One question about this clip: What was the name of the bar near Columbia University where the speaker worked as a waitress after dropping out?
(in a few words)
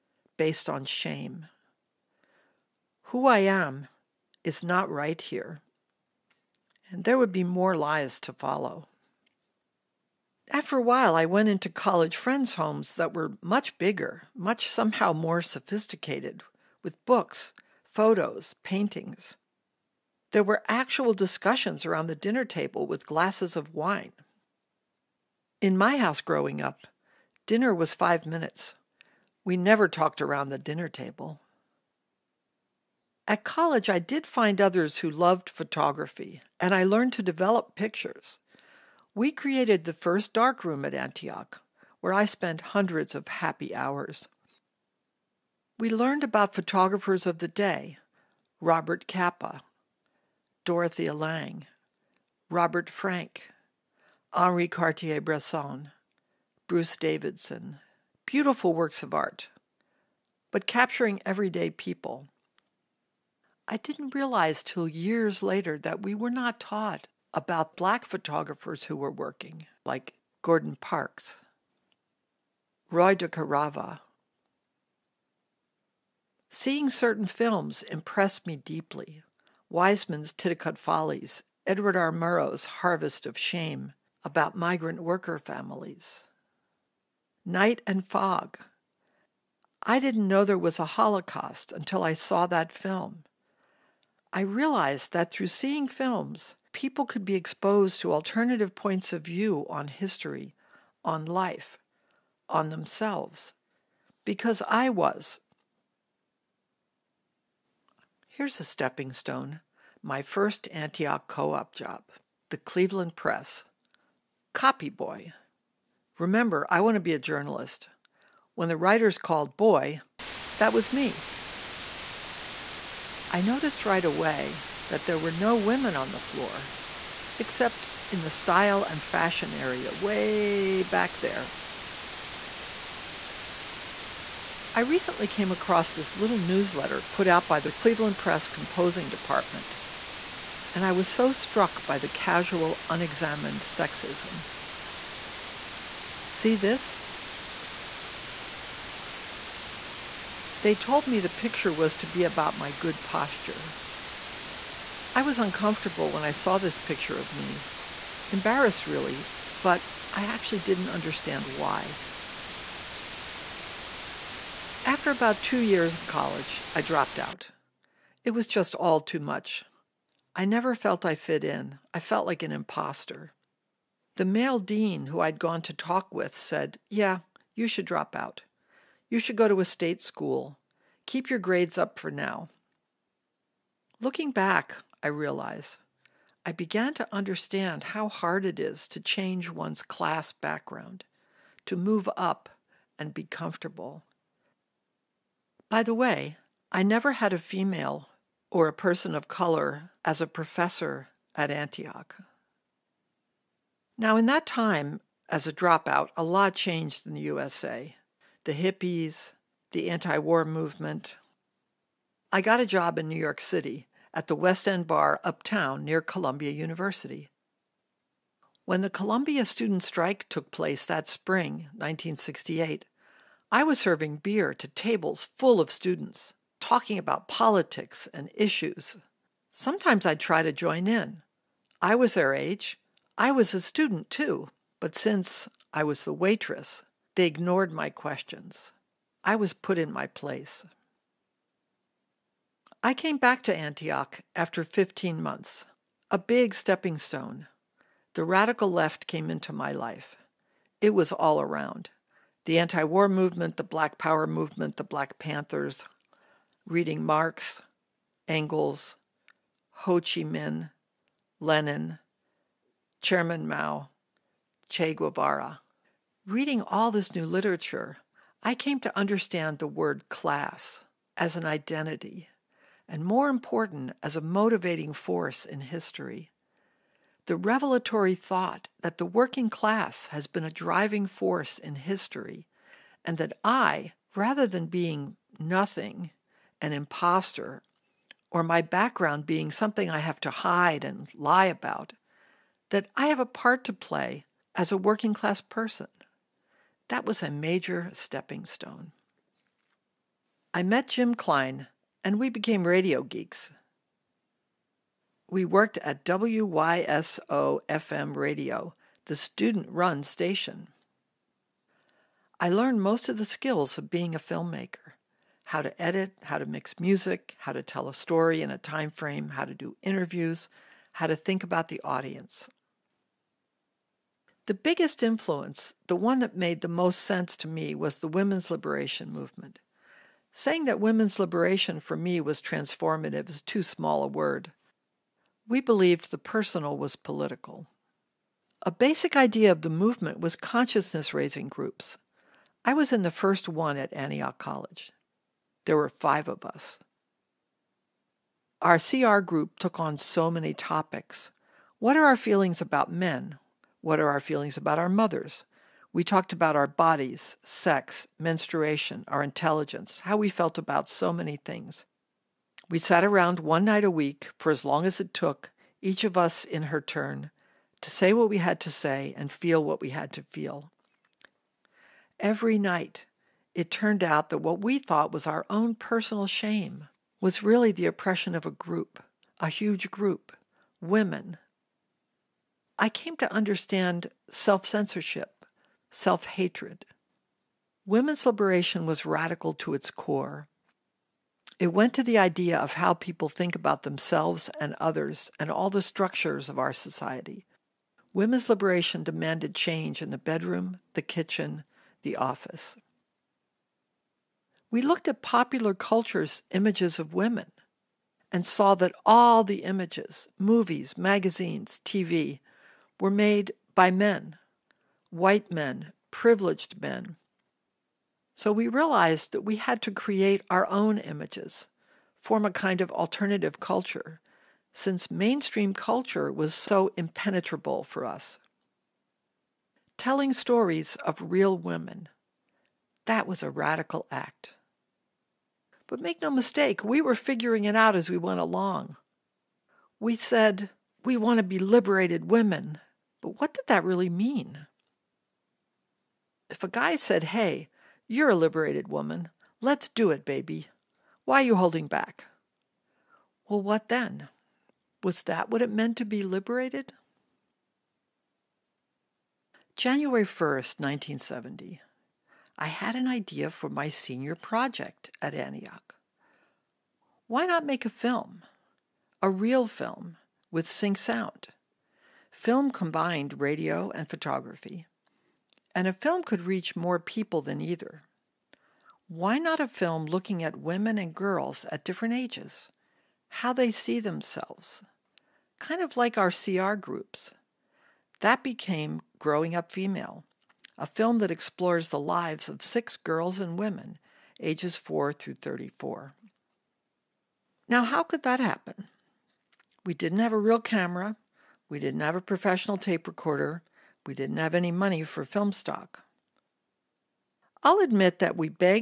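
West End Bar.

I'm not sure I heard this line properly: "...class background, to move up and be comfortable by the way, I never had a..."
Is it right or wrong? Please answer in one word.
right.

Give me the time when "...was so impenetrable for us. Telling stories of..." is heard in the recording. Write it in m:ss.
7:06.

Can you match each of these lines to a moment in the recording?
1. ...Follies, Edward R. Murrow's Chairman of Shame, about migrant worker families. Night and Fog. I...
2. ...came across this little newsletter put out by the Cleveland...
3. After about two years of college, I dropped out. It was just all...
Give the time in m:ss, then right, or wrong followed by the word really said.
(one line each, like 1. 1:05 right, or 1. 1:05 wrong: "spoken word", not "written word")
1. 1:20 wrong: "Harvest", not "Chairman"
2. 2:15 right
3. 2:44 right.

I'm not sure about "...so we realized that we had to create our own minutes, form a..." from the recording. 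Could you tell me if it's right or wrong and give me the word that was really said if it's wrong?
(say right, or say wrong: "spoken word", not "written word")
wrong: "images", not "minutes".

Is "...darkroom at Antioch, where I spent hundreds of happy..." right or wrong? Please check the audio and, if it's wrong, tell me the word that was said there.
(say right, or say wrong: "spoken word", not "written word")
right.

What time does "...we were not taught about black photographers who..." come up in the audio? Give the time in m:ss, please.
1:06.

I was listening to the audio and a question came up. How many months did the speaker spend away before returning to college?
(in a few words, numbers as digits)
15.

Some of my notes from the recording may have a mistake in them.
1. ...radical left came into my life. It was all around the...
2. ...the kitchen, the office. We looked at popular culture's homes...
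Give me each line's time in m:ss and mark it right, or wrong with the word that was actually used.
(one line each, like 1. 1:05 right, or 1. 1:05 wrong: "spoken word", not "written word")
1. 4:08 right
2. 6:40 wrong: "images", not "homes".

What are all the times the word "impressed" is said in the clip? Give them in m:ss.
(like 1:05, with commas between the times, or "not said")
1:17.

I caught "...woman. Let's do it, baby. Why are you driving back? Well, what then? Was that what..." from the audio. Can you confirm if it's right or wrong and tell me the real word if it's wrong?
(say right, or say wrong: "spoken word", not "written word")
wrong: "holding", not "driving".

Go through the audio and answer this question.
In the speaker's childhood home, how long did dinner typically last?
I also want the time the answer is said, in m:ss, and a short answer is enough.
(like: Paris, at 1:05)
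5 minutes, at 0:27.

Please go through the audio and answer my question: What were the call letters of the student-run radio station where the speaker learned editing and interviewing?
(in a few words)
WYSO FM.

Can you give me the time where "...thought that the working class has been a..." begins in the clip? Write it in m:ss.
4:38.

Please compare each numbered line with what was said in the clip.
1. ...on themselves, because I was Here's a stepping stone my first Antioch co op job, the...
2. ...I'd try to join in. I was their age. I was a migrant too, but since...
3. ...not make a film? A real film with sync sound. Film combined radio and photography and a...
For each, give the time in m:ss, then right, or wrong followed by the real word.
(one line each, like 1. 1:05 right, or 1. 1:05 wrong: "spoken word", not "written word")
1. 1:42 right
2. 3:50 wrong: "student", not "migrant"
3. 7:47 right.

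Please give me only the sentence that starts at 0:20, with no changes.
There were actual discussions around the dinner table with glasses of wine.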